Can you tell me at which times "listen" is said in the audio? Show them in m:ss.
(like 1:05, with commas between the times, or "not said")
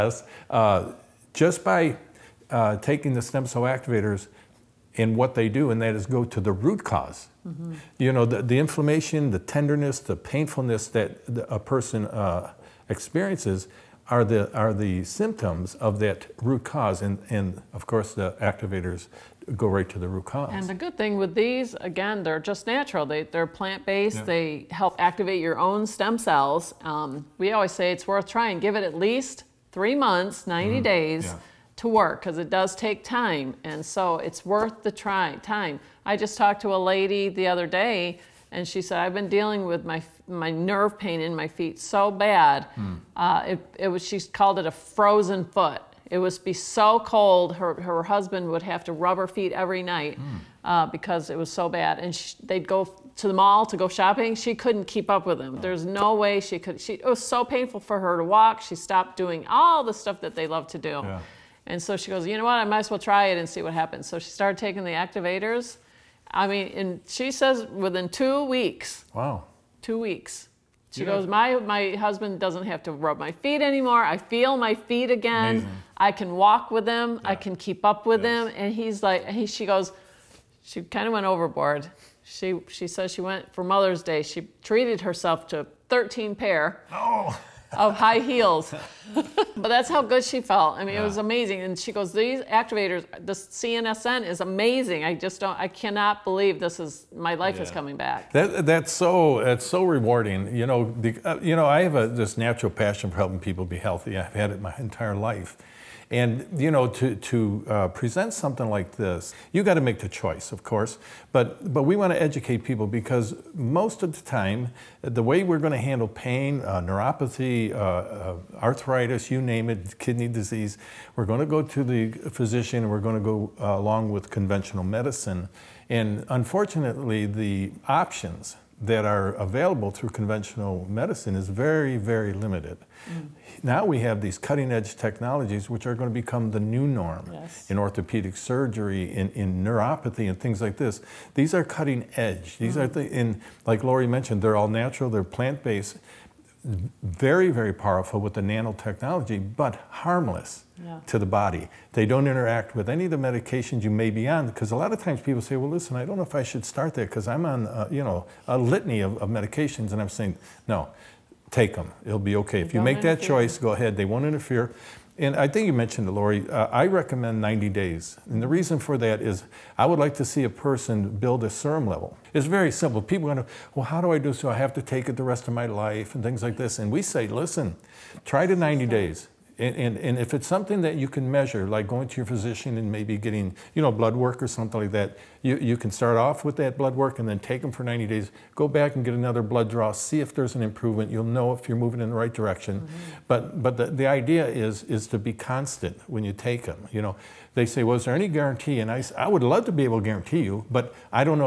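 2:35, 2:57.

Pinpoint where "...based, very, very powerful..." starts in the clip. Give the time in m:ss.
2:25.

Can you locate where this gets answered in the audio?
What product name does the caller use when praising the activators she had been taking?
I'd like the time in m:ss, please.
1:33.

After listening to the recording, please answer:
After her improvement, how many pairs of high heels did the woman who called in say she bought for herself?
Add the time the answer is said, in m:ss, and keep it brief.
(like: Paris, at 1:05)
13, at 1:25.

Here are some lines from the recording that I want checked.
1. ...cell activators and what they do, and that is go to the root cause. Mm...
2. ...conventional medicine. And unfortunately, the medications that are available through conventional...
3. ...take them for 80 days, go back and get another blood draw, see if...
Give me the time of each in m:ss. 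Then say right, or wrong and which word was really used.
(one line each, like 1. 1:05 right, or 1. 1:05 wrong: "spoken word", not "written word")
1. 0:03 right
2. 2:04 wrong: "options", not "medications"
3. 3:07 wrong: "90", not "80".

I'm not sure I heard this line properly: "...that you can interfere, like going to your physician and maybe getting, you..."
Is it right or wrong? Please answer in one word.
wrong.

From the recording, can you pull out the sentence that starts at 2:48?
And the reason for that is I would like to see a person build a serum level.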